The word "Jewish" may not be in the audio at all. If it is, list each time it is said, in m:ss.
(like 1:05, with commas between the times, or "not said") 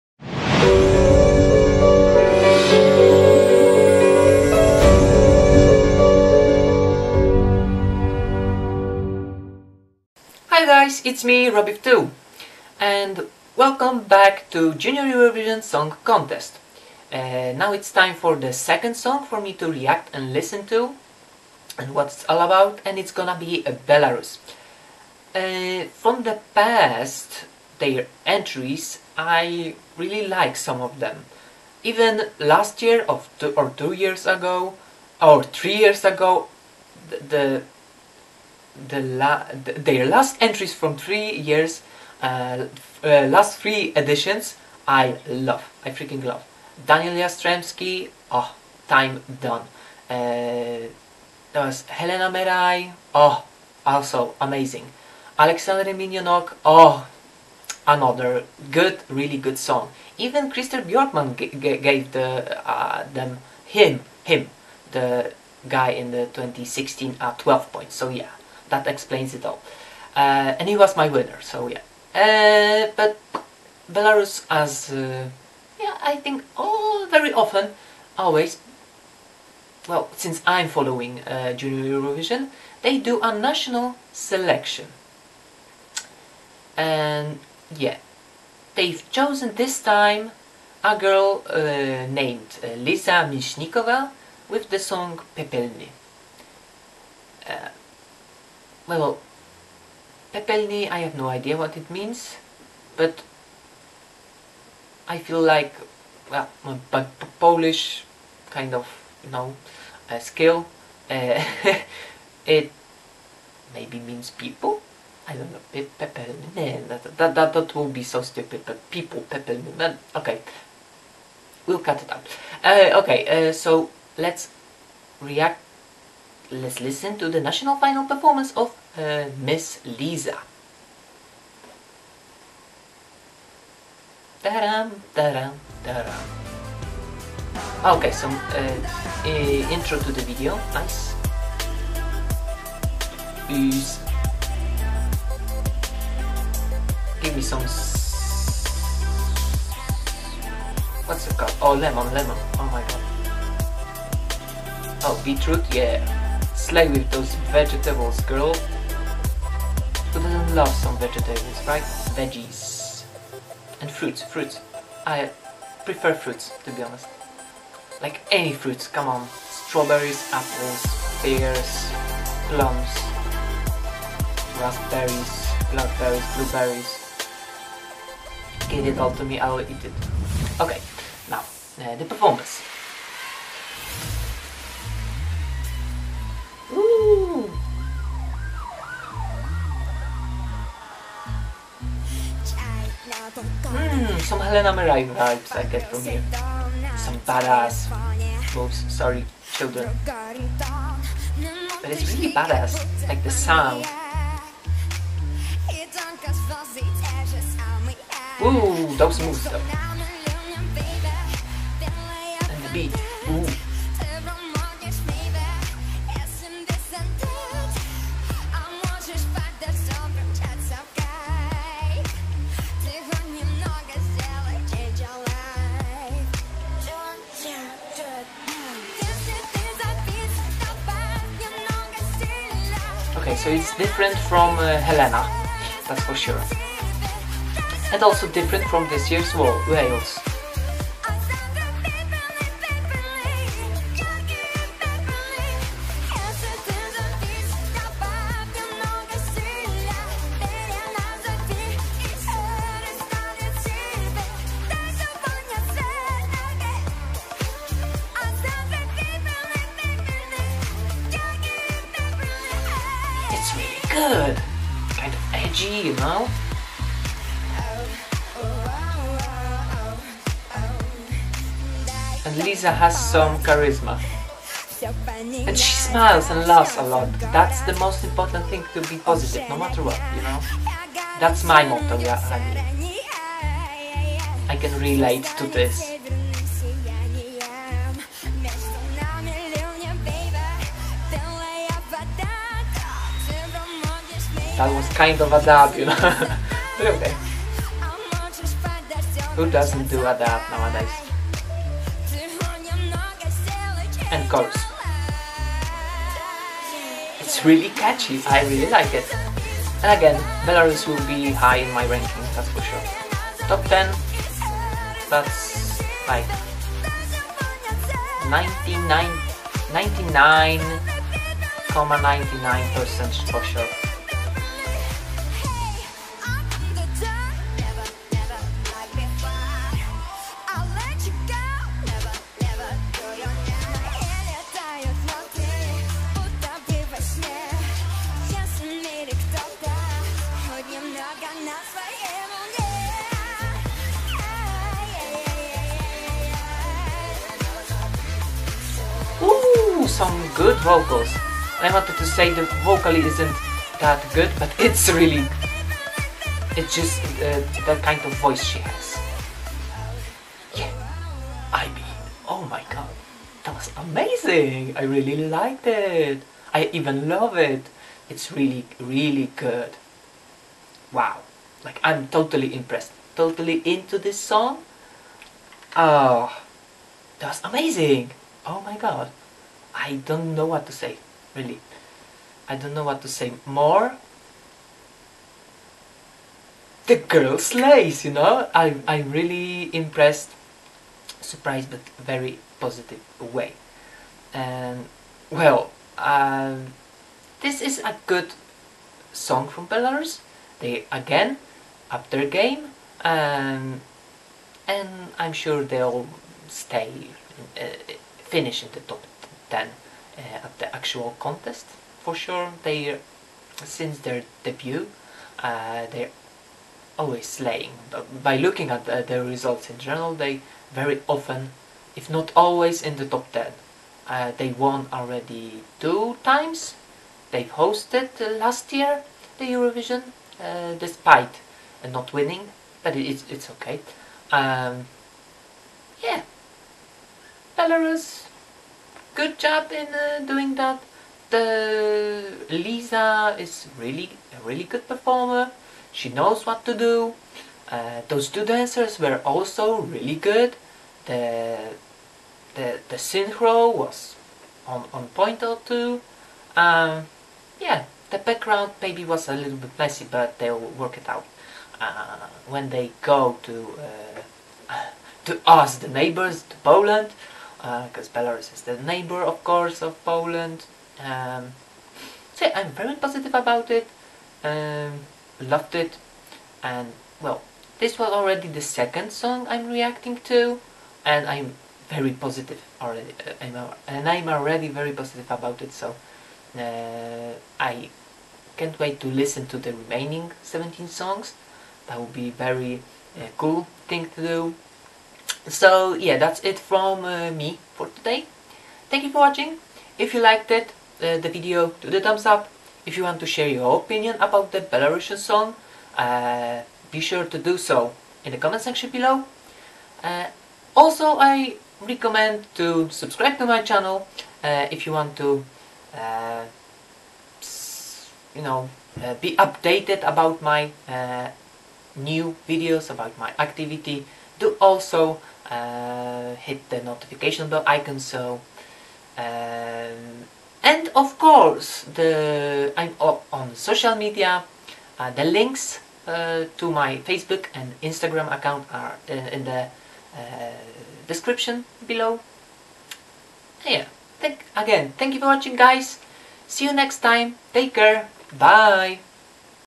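not said.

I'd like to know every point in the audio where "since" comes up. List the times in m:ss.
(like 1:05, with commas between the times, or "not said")
1:20, 6:53.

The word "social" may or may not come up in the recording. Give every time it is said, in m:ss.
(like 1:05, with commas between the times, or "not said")
8:53.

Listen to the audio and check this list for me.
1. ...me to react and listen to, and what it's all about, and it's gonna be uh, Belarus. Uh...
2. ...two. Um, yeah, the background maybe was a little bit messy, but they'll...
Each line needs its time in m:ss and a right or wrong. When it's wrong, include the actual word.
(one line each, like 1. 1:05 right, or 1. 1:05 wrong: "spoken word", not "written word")
1. 0:19 right
2. 7:35 right.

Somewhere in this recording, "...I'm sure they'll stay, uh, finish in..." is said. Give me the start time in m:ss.
6:45.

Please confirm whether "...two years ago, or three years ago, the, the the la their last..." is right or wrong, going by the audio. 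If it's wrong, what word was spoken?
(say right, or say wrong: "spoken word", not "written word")
right.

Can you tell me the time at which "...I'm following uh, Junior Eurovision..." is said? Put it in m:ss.
1:20.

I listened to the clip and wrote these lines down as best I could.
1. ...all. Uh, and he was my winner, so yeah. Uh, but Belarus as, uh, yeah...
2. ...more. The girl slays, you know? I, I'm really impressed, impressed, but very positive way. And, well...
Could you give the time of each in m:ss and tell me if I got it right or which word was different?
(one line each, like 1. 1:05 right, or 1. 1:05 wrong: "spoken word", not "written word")
1. 1:09 right
2. 6:23 wrong: "surprised", not "impressed".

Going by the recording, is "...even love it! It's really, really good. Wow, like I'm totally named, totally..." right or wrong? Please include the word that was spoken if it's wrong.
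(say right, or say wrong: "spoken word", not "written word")
wrong: "impressed", not "named".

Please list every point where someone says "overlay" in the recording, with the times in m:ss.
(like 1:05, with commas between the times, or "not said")
not said.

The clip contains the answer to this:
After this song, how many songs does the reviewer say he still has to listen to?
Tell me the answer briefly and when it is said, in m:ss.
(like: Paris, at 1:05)
17, at 8:10.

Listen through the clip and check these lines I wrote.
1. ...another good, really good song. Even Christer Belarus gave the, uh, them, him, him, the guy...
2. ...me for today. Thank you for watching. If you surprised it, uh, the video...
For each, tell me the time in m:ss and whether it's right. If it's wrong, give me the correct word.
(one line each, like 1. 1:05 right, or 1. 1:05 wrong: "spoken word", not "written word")
1. 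0:57 wrong: "Björkman", not "Belarus"
2. 8:17 wrong: "liked", not "surprised".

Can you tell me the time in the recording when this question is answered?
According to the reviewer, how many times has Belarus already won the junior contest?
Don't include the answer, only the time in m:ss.
7:05.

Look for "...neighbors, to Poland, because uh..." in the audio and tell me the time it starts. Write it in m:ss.
7:45.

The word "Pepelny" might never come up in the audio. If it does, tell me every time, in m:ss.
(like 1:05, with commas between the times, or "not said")
1:35, 1:40, 1:59.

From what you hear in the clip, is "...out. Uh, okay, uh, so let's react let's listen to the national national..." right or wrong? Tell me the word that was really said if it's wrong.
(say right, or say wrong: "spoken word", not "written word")
wrong: "final", not "national".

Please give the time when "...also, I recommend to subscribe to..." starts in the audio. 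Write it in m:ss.
8:30.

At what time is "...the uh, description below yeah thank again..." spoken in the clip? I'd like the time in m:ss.
8:59.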